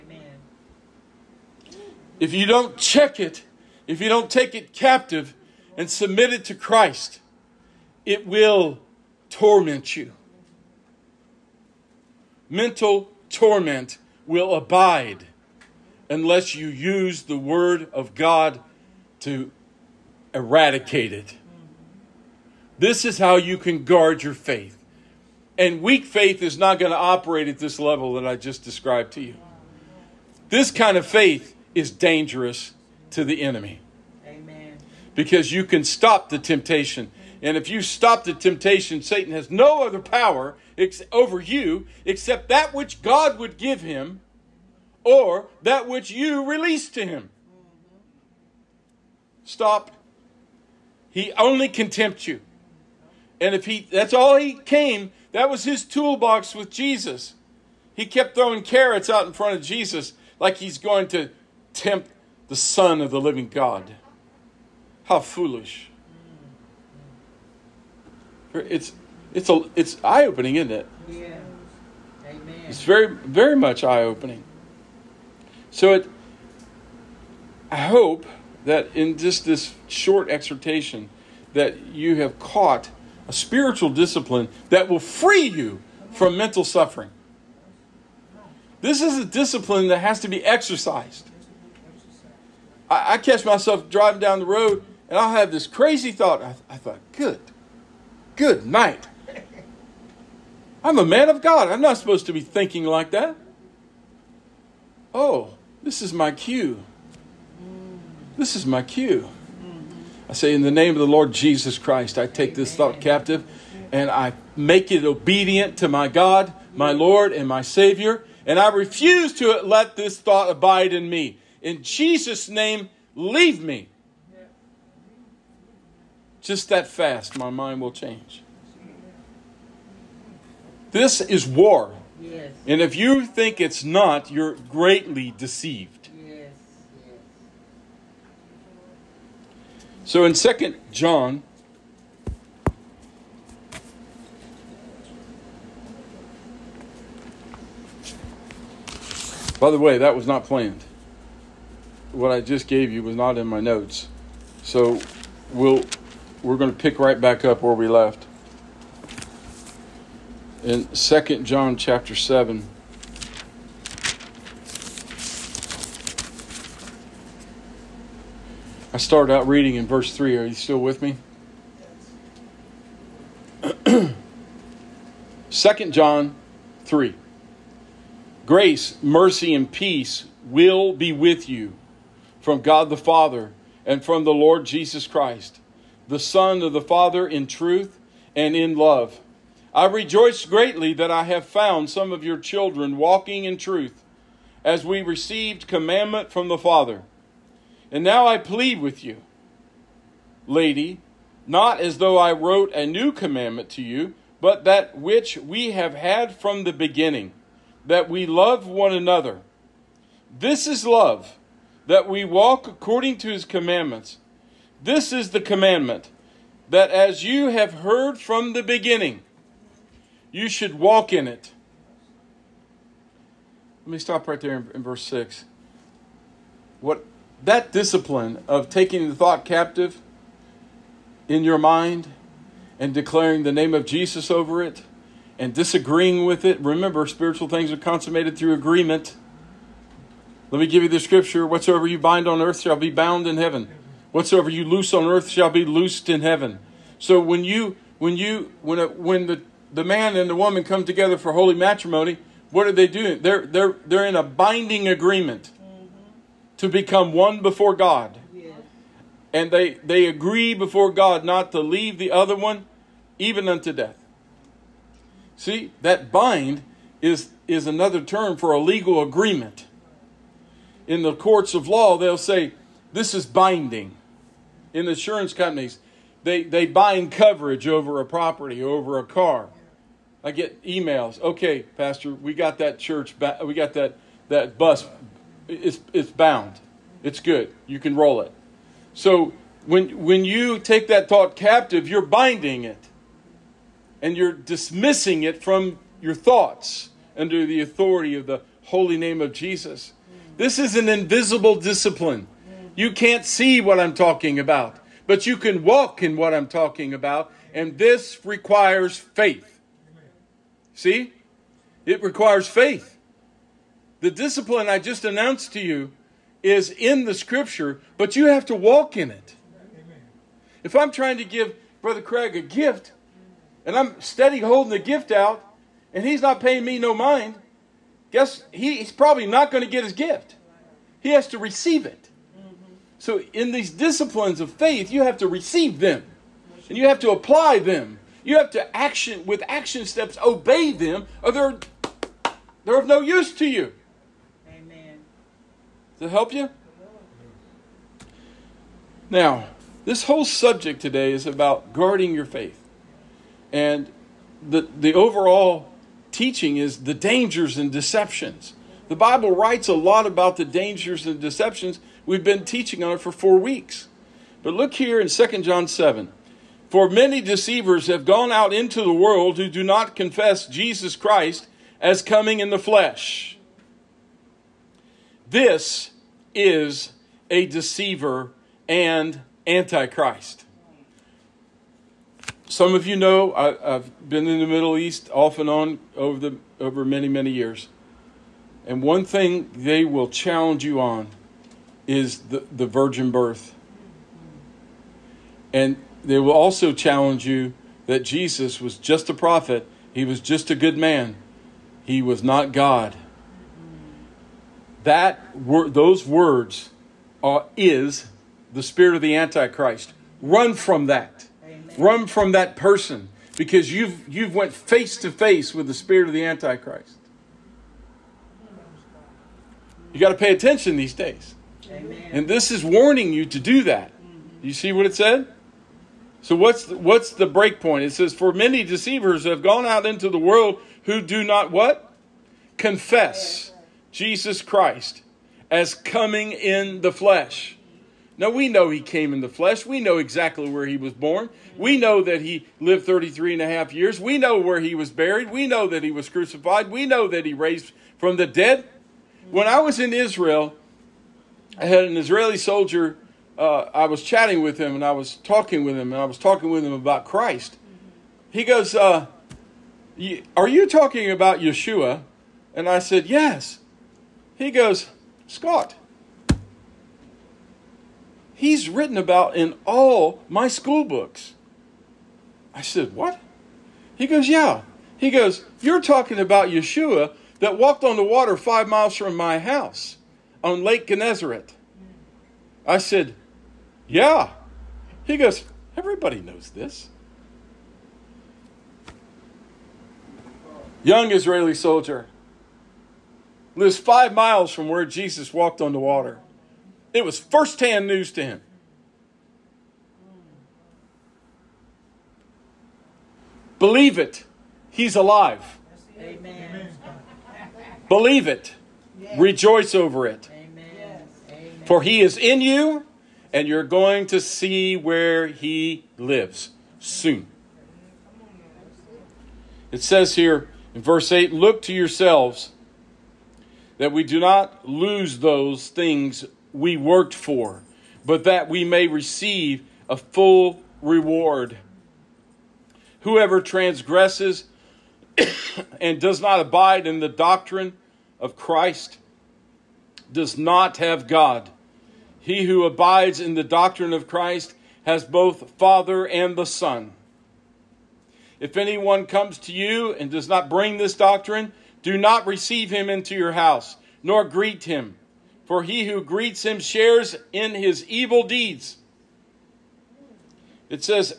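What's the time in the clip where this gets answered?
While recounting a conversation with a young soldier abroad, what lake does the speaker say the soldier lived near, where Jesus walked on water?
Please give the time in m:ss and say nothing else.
8:00.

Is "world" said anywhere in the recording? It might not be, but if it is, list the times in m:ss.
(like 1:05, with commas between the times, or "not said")
6:08, 7:10.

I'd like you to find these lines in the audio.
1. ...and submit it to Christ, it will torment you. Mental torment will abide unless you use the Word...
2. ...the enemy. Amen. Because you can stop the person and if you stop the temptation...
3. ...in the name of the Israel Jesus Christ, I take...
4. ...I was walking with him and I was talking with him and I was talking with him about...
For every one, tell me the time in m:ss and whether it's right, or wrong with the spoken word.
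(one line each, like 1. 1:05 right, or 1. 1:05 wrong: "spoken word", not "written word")
1. 0:05 right
2. 0:33 wrong: "temptation", not "person"
3. 1:50 wrong: "Lord", not "Israel"
4. 7:33 wrong: "chatting", not "walking".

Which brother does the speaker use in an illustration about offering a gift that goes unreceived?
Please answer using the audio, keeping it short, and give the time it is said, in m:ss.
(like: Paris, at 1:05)
Brother Craig, at 5:21.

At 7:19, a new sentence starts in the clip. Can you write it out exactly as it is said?
We know exactly where he was born.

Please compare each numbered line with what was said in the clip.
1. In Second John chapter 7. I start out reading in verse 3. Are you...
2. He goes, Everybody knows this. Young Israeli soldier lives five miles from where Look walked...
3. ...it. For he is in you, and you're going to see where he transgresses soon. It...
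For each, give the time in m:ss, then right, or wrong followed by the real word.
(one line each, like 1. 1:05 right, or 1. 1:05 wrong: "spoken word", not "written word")
1. 2:40 right
2. 8:05 wrong: "Jesus", not "Look"
3. 8:30 wrong: "lives", not "transgresses".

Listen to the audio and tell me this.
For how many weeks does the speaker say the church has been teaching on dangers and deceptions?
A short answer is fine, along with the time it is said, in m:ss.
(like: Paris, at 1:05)
4, at 6:03.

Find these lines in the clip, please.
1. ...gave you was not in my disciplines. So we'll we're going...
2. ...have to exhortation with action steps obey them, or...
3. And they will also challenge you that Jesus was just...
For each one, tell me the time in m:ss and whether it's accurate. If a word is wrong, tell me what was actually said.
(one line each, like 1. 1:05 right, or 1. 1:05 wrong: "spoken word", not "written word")
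1. 2:32 wrong: "notes", not "disciplines"
2. 5:38 wrong: "action", not "exhortation"
3. 6:35 right.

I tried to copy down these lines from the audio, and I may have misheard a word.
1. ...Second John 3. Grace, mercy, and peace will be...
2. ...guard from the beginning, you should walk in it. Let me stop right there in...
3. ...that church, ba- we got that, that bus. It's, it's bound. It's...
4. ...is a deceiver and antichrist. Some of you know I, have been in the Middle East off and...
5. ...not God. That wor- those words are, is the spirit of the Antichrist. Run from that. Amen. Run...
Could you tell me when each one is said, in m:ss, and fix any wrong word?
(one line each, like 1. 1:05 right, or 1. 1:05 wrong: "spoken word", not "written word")
1. 2:55 right
2. 3:37 wrong: "heard", not "guard"
3. 4:42 right
4. 6:16 right
5. 6:42 right.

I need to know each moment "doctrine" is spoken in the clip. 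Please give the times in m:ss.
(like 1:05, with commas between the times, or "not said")
8:57, 9:03, 9:10.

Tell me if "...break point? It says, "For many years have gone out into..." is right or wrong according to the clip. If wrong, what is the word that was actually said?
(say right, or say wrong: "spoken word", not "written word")
wrong: "deceivers", not "years".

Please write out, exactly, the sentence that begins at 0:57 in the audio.
He kept throwing carrots out in front of Jesus like he's going to tempt the son of the living God.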